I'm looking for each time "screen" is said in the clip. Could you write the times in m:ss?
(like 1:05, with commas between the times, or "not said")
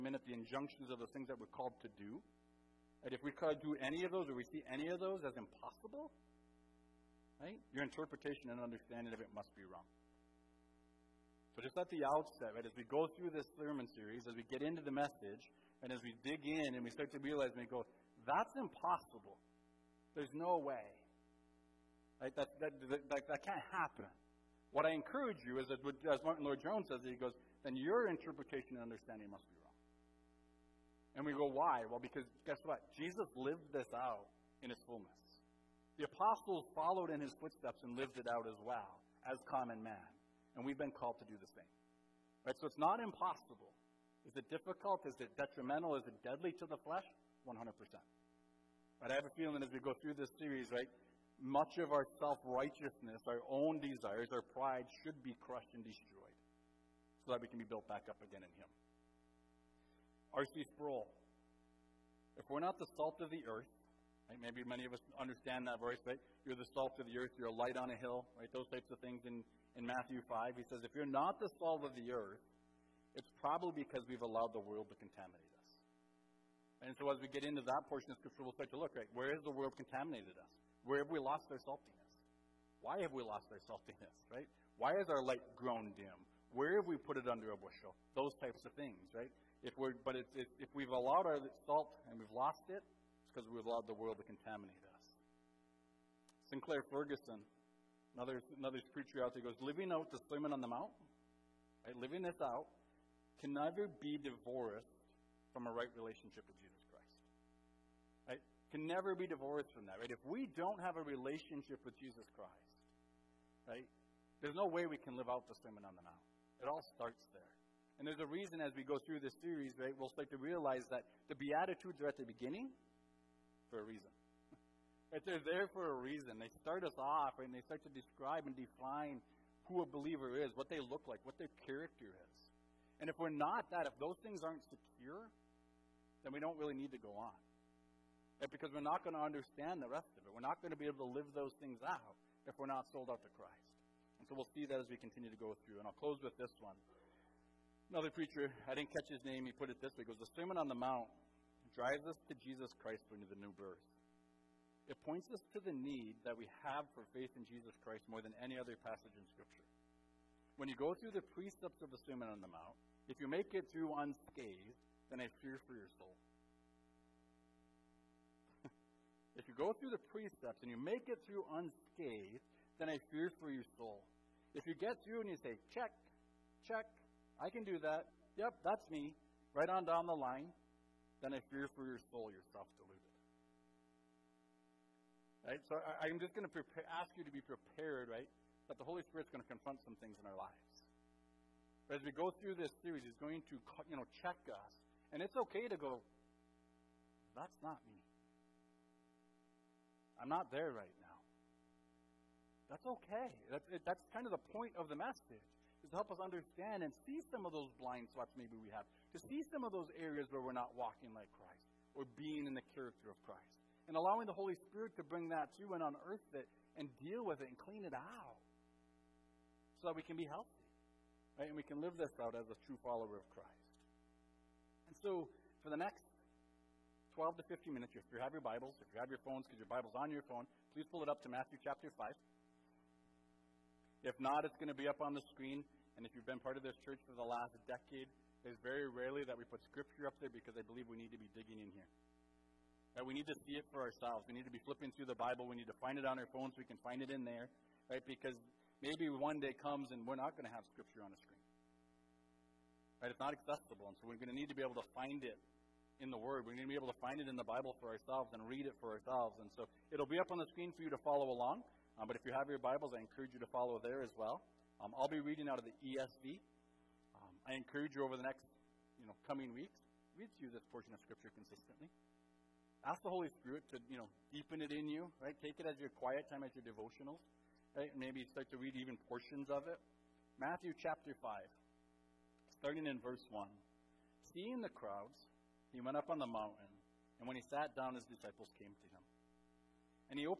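3:55, 4:11, 4:20.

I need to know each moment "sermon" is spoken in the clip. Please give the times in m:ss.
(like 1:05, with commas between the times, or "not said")
0:13, 1:40, 1:55, 2:30, 2:42.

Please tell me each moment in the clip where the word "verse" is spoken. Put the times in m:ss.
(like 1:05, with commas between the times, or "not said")
1:05, 4:42.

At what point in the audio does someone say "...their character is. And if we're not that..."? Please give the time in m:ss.
2:11.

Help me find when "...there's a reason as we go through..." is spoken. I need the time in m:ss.
1:58.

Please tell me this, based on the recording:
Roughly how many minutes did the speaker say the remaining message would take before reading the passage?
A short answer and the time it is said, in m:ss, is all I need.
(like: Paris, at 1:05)
12 to 15, at 3:47.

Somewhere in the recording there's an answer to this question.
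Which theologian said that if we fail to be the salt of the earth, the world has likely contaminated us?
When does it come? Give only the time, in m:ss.
1:00.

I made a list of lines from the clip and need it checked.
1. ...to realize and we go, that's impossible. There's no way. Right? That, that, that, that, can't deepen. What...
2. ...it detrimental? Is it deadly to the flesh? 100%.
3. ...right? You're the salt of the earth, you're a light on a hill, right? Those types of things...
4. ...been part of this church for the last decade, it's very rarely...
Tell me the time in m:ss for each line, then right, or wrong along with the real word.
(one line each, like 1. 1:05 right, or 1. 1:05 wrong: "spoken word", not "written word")
1. 0:17 wrong: "happen", not "deepen"
2. 0:45 right
3. 1:06 right
4. 3:56 right.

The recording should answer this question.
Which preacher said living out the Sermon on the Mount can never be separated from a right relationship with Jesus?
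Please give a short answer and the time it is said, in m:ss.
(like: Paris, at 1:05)
Sinclair Ferguson, at 1:36.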